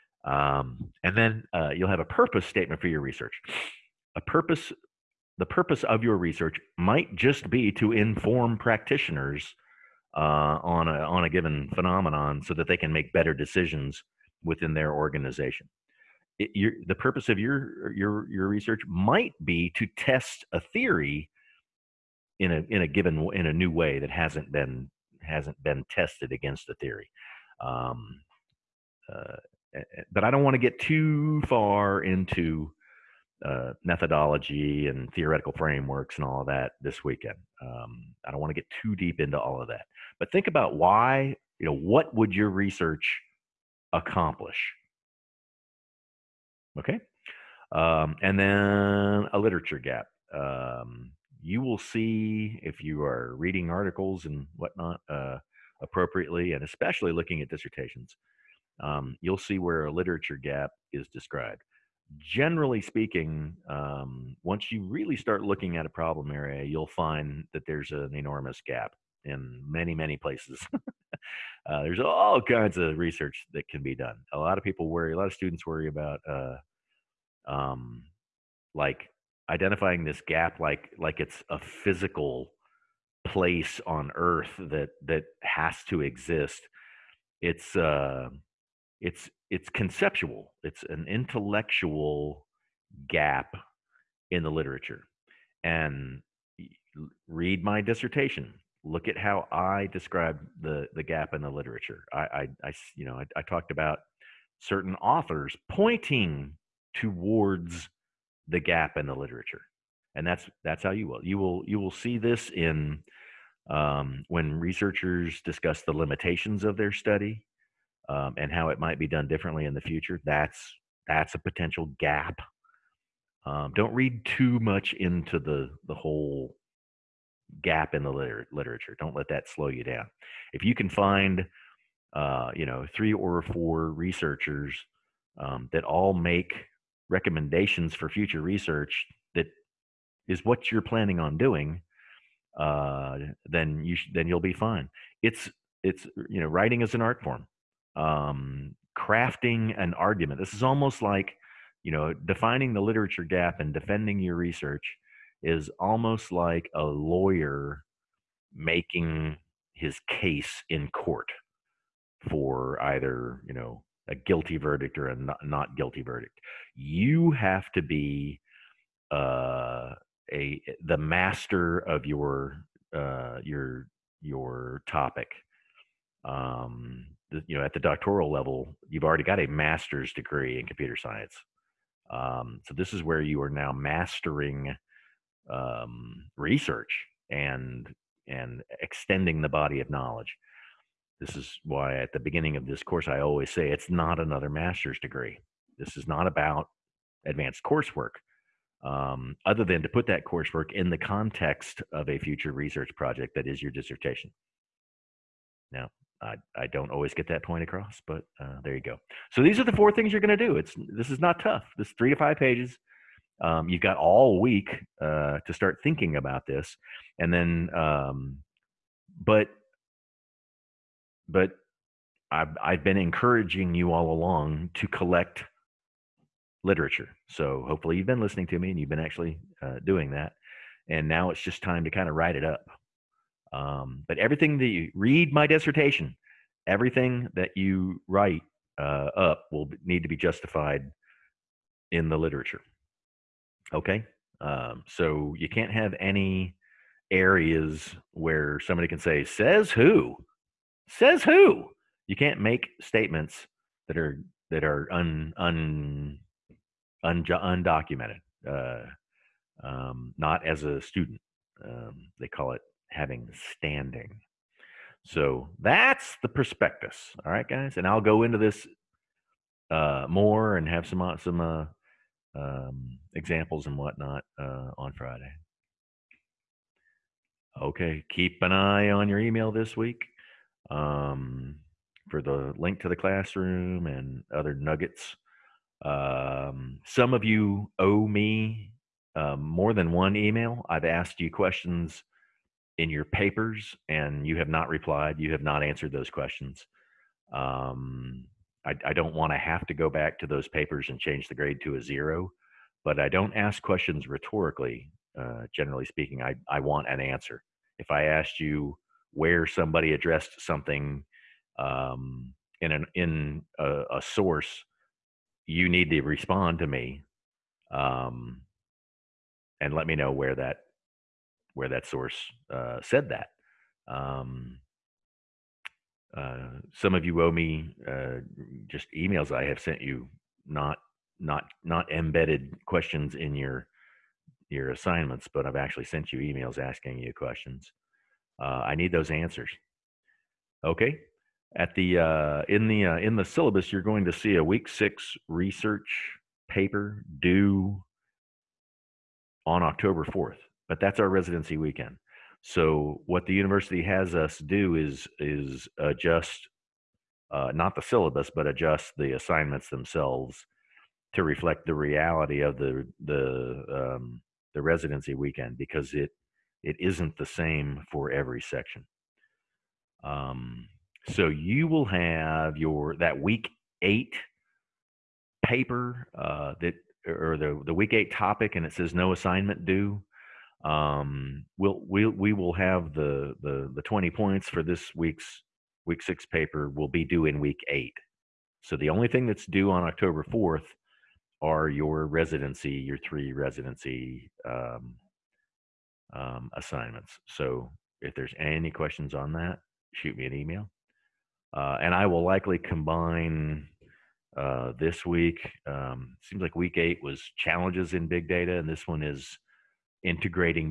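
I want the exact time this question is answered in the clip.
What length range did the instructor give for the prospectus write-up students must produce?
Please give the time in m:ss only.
3:31.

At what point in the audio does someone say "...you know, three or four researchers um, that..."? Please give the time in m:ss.
2:12.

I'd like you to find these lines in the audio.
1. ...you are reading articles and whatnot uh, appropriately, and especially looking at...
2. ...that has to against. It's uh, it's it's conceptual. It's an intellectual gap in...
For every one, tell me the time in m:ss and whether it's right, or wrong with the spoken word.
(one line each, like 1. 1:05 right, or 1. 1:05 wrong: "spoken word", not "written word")
1. 0:52 right
2. 1:25 wrong: "exist", not "against".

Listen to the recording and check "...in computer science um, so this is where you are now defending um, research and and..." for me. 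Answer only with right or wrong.
wrong.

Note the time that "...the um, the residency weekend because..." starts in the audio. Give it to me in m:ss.
6:03.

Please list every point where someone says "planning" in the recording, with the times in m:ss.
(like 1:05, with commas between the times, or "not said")
2:20.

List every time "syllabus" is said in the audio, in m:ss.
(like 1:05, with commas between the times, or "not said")
5:43, 5:57.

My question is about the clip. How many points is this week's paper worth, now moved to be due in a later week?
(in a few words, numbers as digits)
20.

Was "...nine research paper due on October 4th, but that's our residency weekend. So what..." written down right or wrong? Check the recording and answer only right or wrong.
wrong.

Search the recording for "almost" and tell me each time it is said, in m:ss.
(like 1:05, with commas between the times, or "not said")
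2:30, 2:35.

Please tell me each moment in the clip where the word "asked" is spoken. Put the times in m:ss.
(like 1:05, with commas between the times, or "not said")
4:50, 5:08.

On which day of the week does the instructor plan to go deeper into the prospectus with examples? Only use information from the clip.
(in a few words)
Friday.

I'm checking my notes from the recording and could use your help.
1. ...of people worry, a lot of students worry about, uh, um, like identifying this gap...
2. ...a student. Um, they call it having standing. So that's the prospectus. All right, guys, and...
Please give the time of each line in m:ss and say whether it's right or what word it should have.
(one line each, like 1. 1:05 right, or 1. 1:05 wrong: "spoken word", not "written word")
1. 1:14 right
2. 4:20 right.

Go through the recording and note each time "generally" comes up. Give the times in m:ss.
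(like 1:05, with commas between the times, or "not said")
1:02, 5:05.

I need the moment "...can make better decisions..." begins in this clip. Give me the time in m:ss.
0:12.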